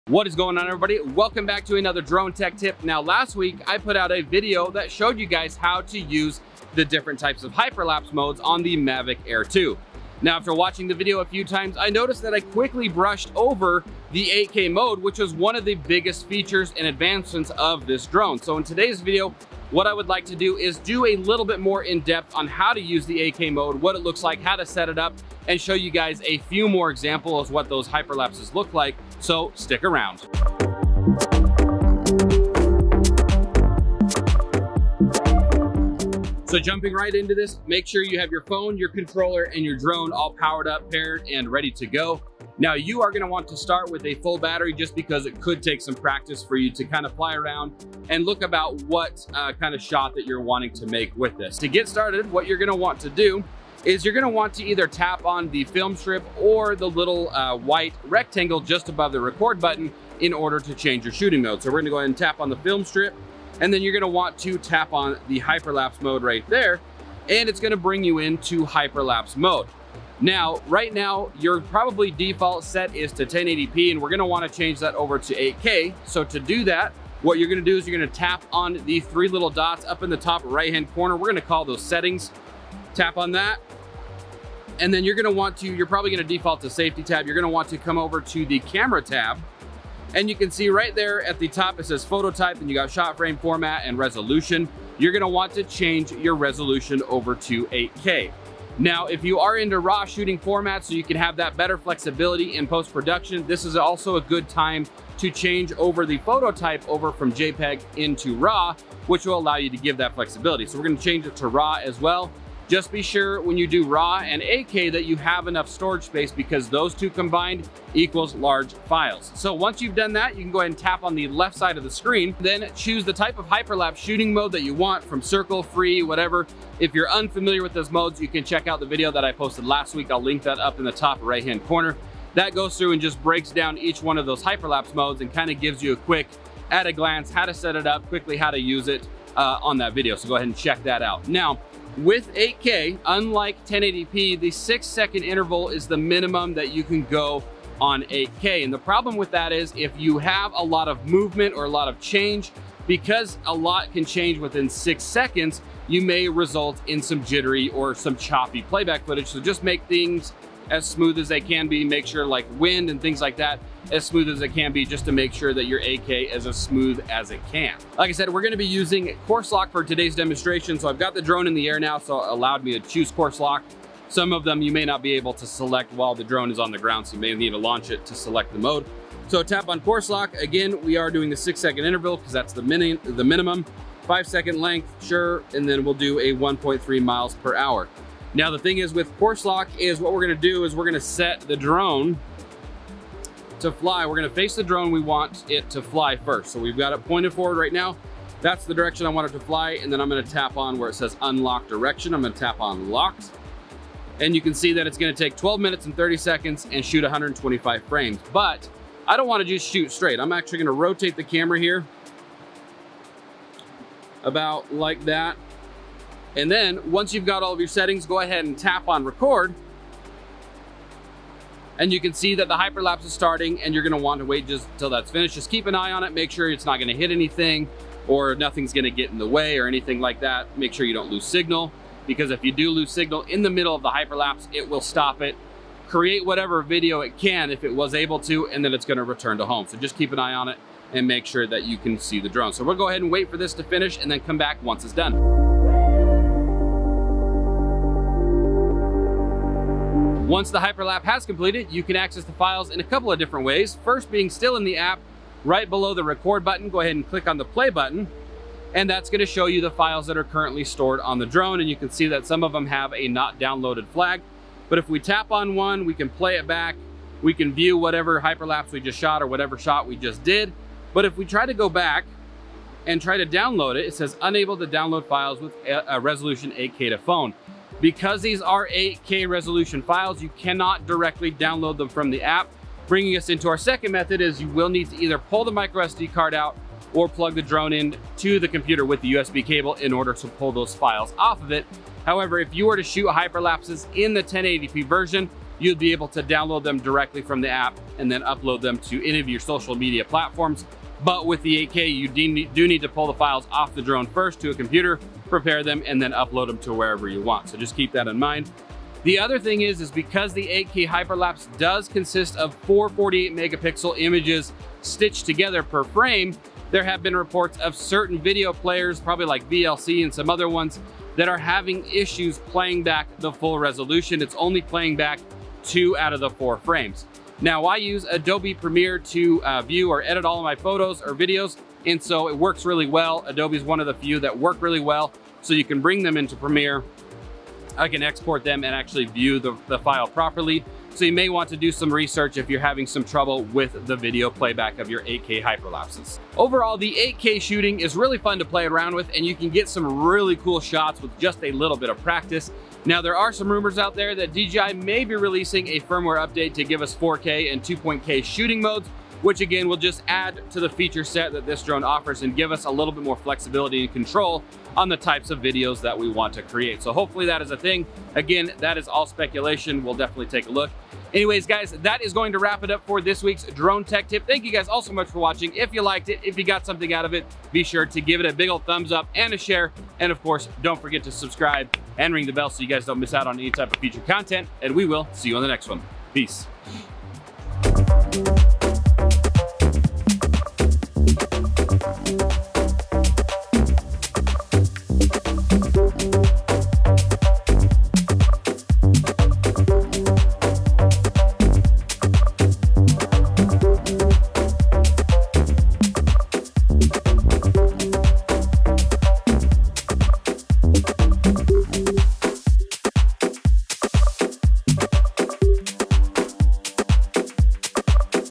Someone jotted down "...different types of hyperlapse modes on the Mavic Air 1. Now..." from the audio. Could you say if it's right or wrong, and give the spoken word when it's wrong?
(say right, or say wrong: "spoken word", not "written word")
wrong: "2", not "1".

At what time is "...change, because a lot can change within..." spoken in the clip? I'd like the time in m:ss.
2:31.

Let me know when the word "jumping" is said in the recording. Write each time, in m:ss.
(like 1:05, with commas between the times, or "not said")
0:36.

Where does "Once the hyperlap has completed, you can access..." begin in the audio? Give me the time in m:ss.
4:10.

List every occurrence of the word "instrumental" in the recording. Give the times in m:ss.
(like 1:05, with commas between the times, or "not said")
not said.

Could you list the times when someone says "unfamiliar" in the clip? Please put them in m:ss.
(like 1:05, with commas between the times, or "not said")
2:07.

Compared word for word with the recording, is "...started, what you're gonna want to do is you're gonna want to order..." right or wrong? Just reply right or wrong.
wrong.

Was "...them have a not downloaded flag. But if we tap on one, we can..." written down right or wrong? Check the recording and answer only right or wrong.
right.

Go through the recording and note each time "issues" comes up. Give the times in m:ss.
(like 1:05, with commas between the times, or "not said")
5:21.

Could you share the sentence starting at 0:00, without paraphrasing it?
Welcome back to another drone tech tip.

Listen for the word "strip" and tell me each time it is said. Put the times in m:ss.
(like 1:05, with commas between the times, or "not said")
0:55, 1:02.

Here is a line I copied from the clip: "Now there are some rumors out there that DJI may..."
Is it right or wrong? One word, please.
right.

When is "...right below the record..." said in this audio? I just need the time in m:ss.
4:15.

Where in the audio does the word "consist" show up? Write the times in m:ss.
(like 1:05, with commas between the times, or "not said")
5:11.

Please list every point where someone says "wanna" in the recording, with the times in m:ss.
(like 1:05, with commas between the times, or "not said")
1:14, 3:29.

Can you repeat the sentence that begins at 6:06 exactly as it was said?
So hopefully that is a thing.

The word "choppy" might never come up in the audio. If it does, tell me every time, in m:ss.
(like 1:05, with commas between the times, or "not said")
2:38.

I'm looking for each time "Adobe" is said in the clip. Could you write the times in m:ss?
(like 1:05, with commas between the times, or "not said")
5:28, 5:33.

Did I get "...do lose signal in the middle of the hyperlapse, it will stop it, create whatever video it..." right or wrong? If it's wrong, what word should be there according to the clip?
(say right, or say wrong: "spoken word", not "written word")
right.